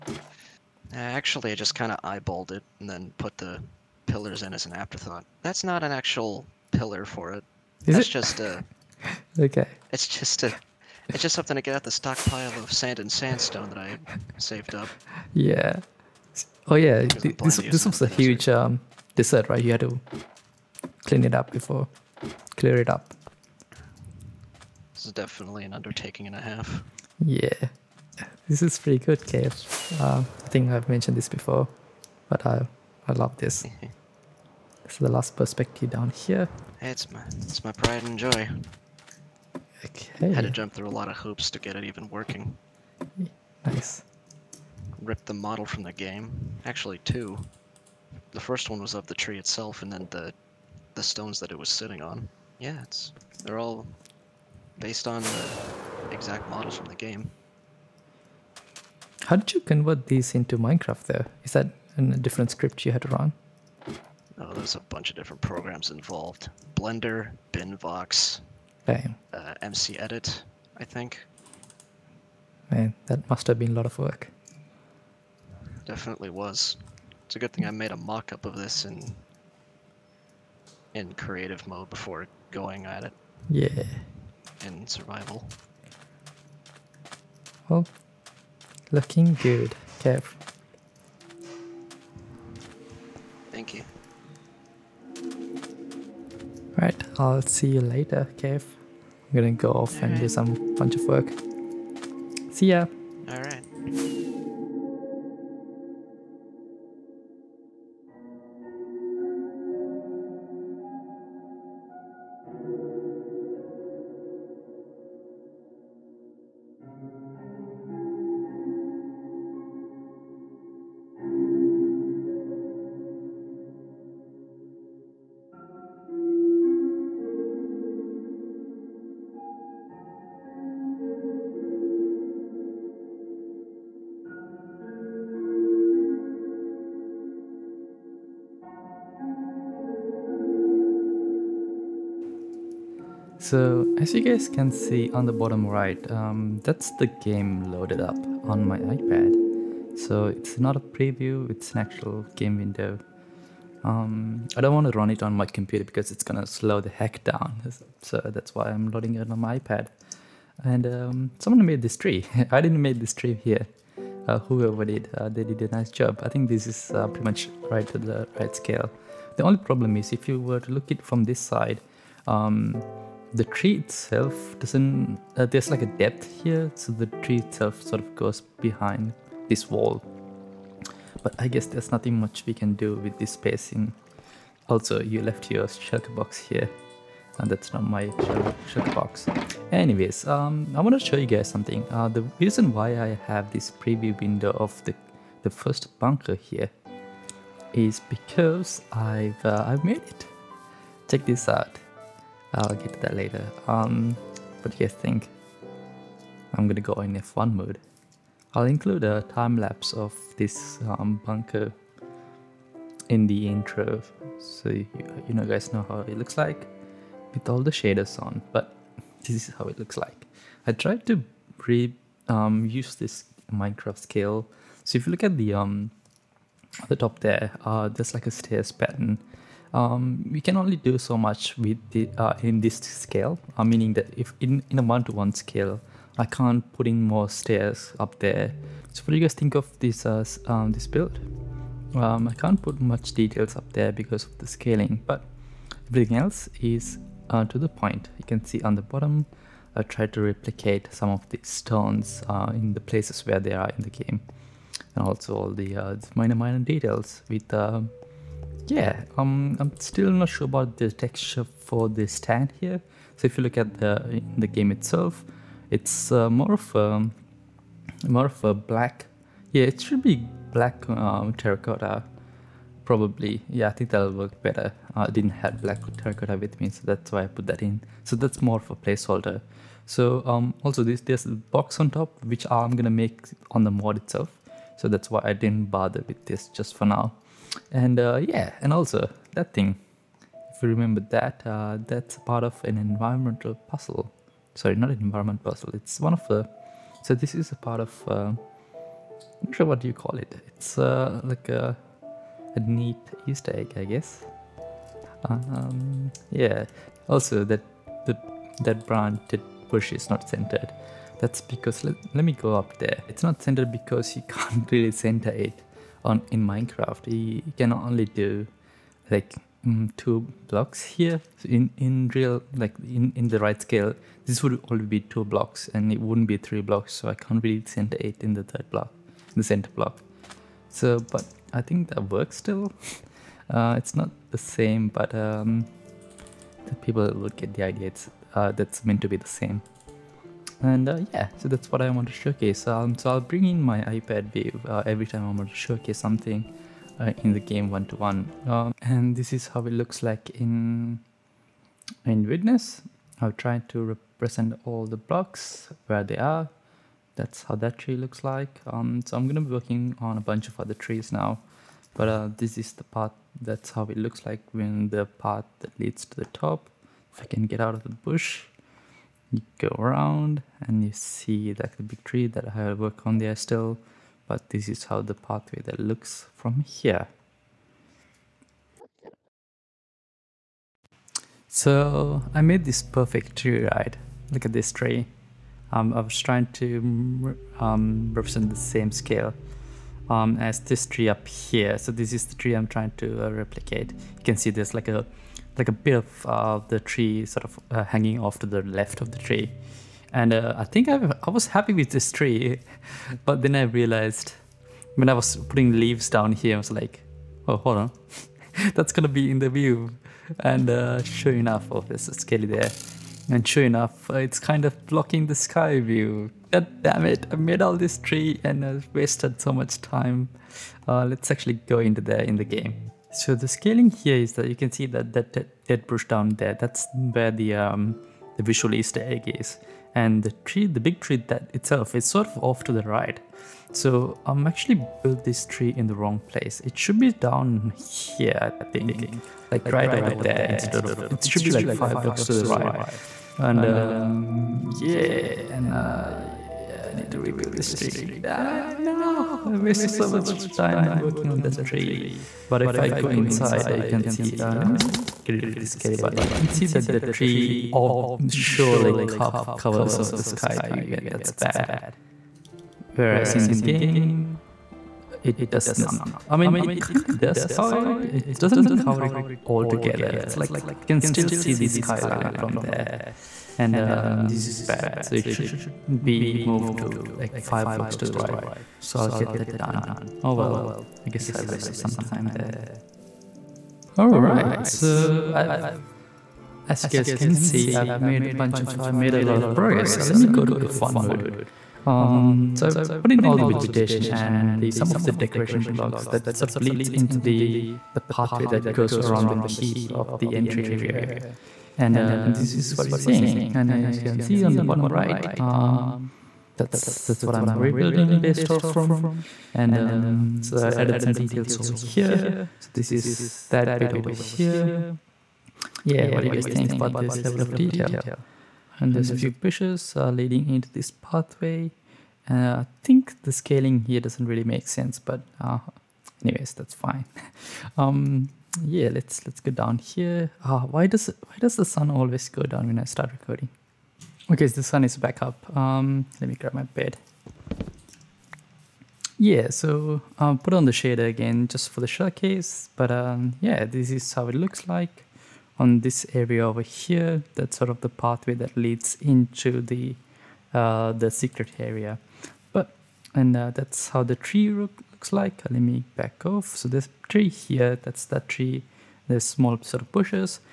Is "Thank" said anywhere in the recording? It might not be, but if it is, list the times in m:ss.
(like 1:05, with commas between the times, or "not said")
1:33.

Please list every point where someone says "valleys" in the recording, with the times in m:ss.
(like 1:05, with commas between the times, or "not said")
not said.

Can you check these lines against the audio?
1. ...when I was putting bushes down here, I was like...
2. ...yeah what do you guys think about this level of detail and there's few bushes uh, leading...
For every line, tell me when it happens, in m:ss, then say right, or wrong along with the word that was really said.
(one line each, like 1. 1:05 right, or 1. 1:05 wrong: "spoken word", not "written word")
1. 6:44 wrong: "leaves", not "bushes"
2. 8:35 right.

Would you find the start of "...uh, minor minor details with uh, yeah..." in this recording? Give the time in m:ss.
4:15.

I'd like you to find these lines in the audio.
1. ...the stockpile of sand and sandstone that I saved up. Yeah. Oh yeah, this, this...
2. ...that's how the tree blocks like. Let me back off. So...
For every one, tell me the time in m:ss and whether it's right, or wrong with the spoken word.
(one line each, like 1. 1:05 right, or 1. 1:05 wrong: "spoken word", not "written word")
1. 0:11 right
2. 9:13 wrong: "looks", not "blocks".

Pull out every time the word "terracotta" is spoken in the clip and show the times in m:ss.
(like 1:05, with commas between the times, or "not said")
4:31, 4:35.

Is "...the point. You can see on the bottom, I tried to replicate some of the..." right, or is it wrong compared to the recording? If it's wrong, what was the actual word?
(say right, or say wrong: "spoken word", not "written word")
right.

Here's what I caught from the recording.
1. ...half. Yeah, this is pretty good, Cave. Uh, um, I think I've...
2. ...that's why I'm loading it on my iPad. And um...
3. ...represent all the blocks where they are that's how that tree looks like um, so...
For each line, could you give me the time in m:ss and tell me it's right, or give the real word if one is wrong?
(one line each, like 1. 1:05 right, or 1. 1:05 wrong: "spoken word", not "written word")
1. 0:26 right
2. 2:38 right
3. 5:53 right.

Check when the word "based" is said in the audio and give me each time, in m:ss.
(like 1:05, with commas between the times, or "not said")
0:54, 8:28.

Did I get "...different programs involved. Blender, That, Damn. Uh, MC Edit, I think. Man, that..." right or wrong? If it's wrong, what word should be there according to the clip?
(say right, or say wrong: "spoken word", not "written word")
wrong: "Binvox", not "That".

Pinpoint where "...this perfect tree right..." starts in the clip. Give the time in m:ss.
6:22.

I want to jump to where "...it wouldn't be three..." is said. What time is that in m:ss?
5:25.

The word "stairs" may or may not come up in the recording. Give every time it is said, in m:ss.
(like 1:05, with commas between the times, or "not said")
3:48, 3:57.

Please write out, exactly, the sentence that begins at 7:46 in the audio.
I mean, it kind of does cover it.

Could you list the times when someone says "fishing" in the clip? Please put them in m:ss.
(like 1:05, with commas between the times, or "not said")
not said.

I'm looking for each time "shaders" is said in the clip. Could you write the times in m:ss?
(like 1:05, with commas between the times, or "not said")
3:37, 9:00.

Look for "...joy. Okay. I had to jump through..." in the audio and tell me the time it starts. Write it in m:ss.
0:38.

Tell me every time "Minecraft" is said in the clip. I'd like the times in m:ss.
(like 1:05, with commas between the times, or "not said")
1:00, 3:43, 5:16.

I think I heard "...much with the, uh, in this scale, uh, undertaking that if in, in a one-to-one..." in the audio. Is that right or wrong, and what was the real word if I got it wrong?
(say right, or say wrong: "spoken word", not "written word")
wrong: "meaning", not "undertaking".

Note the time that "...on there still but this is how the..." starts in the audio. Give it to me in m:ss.
6:13.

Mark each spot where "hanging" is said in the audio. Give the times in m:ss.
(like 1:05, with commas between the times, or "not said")
6:37.